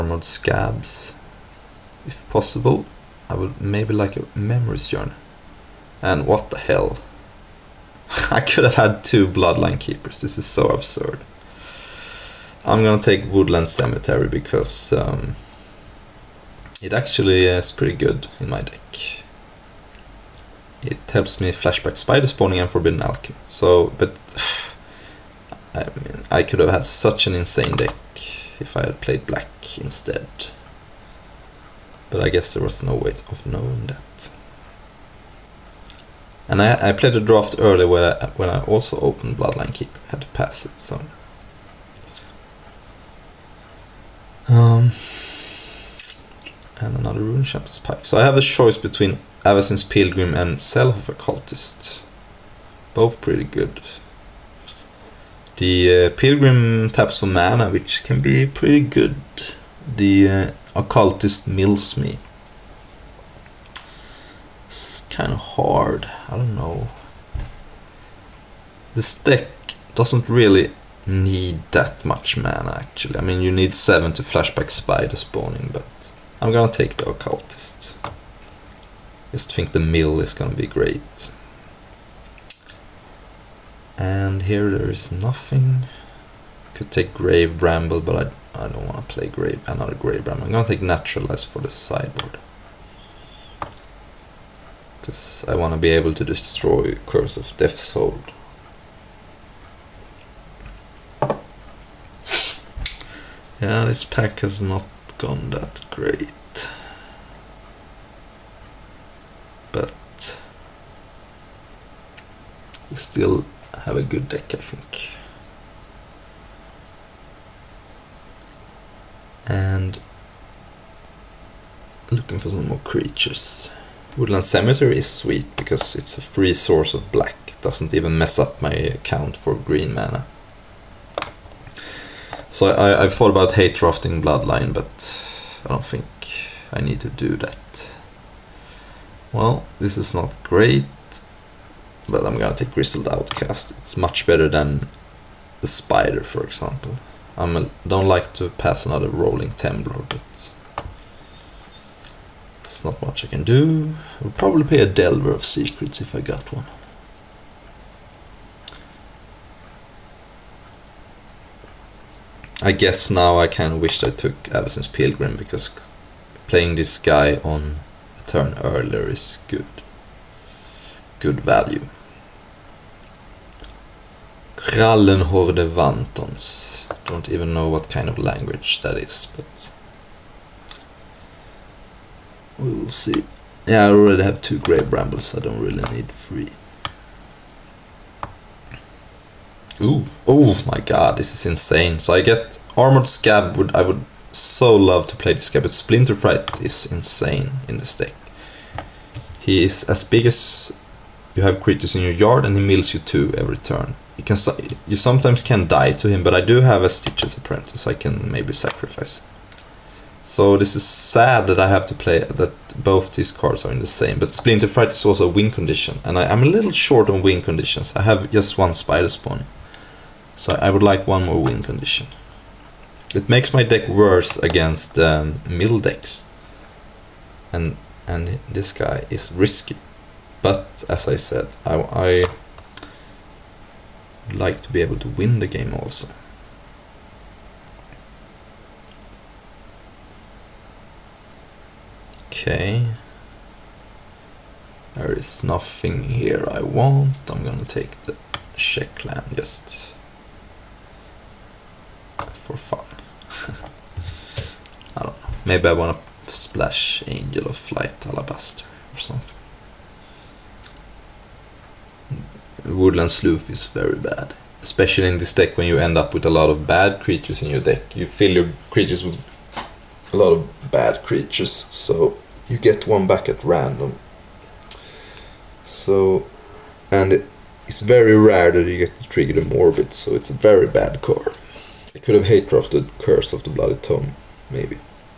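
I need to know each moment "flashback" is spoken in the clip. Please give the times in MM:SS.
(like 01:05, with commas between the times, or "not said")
00:21, 01:14.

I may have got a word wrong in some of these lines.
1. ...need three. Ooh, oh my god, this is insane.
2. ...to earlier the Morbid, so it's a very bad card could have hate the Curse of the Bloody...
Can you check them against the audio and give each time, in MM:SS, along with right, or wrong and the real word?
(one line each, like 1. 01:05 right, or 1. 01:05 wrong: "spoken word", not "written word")
1. 03:05 right
2. 04:39 wrong: "trigger", not "earlier".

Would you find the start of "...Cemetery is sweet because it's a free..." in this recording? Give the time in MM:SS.
02:04.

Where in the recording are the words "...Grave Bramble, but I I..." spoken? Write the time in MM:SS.
01:27.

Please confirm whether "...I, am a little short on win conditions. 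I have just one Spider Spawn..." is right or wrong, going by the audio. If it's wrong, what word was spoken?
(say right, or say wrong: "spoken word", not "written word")
right.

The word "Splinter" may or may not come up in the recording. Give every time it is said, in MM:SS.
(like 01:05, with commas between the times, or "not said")
03:15, 03:34.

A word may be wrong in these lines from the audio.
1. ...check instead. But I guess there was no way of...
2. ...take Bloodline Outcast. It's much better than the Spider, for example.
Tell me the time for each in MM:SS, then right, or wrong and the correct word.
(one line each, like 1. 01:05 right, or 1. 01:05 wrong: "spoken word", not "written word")
1. 00:29 wrong: "black", not "check"
2. 02:22 wrong: "Grizzled", not "Bloodline".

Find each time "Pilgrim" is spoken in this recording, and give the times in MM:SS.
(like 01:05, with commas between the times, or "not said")
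00:49, 00:56, 02:44.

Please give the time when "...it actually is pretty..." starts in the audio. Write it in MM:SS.
00:16.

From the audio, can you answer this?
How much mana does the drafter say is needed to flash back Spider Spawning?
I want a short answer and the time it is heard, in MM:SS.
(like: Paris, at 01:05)
7, at 01:13.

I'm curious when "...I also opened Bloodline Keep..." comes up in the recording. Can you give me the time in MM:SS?
00:38.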